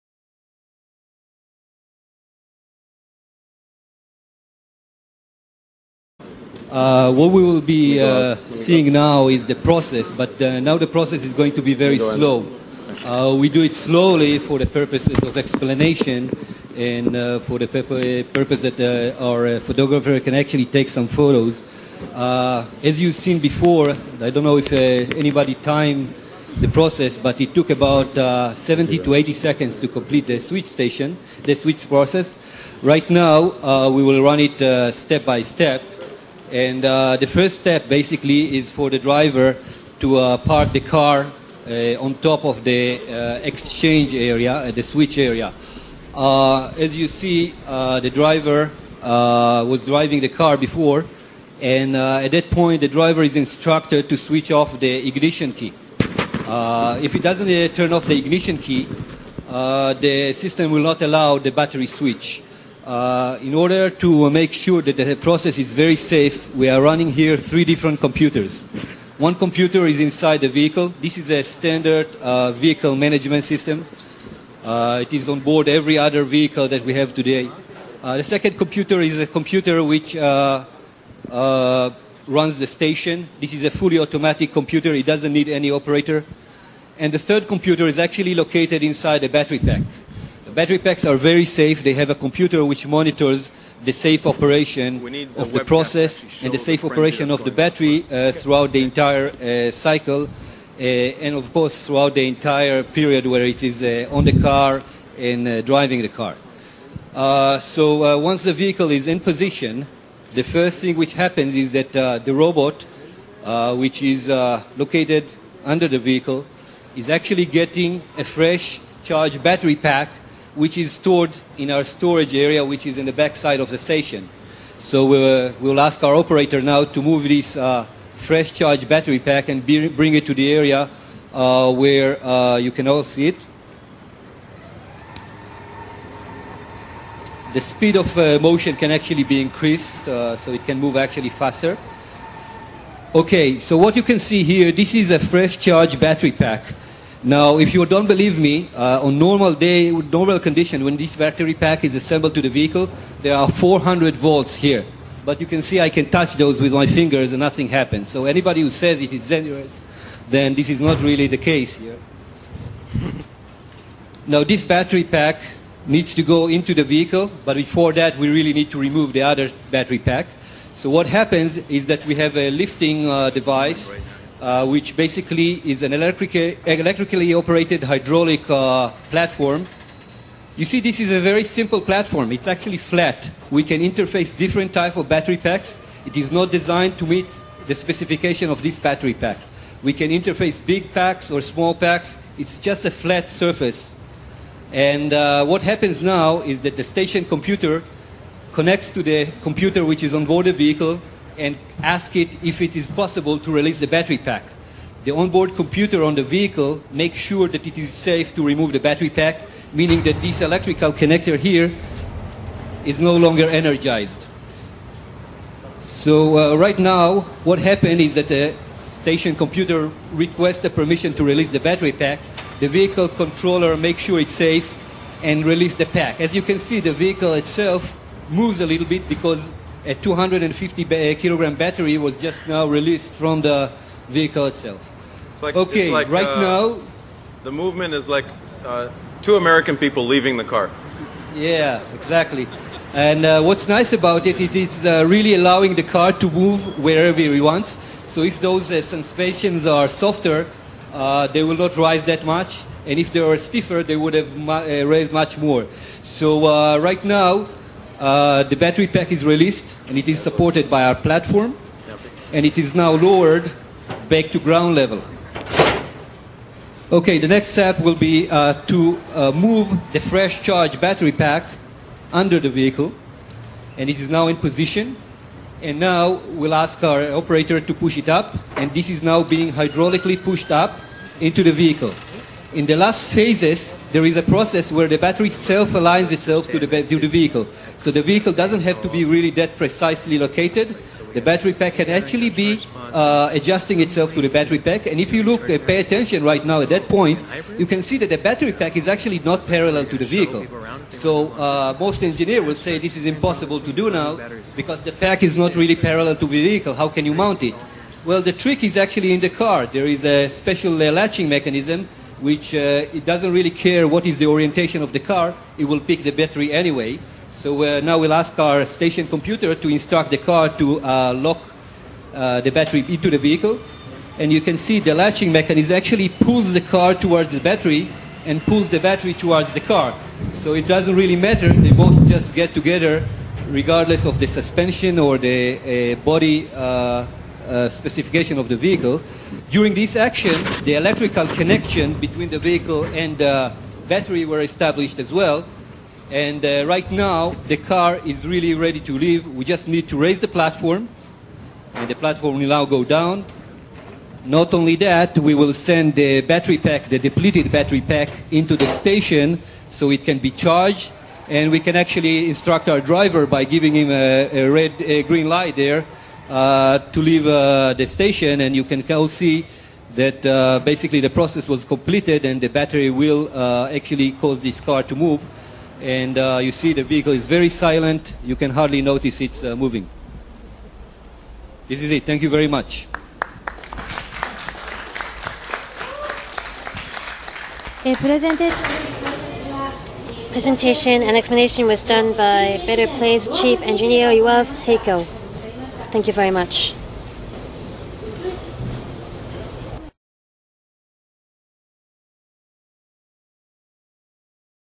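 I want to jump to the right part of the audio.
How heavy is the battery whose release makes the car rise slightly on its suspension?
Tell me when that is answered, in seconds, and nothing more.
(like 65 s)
229 s.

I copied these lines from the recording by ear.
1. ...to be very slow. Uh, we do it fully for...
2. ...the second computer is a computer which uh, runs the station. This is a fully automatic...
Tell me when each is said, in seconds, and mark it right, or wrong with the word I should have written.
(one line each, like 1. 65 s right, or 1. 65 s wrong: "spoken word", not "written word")
1. 11 s wrong: "slowly", not "fully"
2. 78 s right.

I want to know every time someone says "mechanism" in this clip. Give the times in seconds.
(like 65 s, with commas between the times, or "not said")
311 s, 325 s.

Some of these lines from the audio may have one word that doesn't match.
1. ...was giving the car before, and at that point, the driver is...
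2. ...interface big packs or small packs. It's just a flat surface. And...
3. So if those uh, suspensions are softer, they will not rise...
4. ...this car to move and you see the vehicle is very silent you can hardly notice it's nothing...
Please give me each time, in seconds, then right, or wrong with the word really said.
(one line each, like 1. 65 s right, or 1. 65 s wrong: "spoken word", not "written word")
1. 49 s wrong: "driving", not "giving"
2. 190 s right
3. 248 s right
4. 374 s wrong: "moving", not "nothing".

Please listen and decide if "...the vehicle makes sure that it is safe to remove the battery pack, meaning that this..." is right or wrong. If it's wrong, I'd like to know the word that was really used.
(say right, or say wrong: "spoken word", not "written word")
right.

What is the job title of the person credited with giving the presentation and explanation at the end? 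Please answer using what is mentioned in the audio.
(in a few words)
Chief Engineer.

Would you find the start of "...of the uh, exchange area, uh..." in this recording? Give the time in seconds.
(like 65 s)
42 s.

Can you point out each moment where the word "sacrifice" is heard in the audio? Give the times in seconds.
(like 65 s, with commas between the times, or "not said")
not said.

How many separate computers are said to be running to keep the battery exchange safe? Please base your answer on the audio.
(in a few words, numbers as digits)
3.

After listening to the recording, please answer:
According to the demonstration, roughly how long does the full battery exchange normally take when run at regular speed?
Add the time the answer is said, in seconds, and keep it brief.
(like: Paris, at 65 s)
70 to 80 seconds, at 28 s.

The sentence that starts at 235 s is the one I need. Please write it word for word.
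It's like, okay, it's like, right uh, now...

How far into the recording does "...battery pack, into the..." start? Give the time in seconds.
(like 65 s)
357 s.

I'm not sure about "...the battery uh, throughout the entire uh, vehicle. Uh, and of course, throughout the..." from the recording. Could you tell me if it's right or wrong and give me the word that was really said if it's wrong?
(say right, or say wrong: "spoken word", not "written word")
wrong: "cycle", not "vehicle".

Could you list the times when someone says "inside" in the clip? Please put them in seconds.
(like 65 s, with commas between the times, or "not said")
70 s, 88 s.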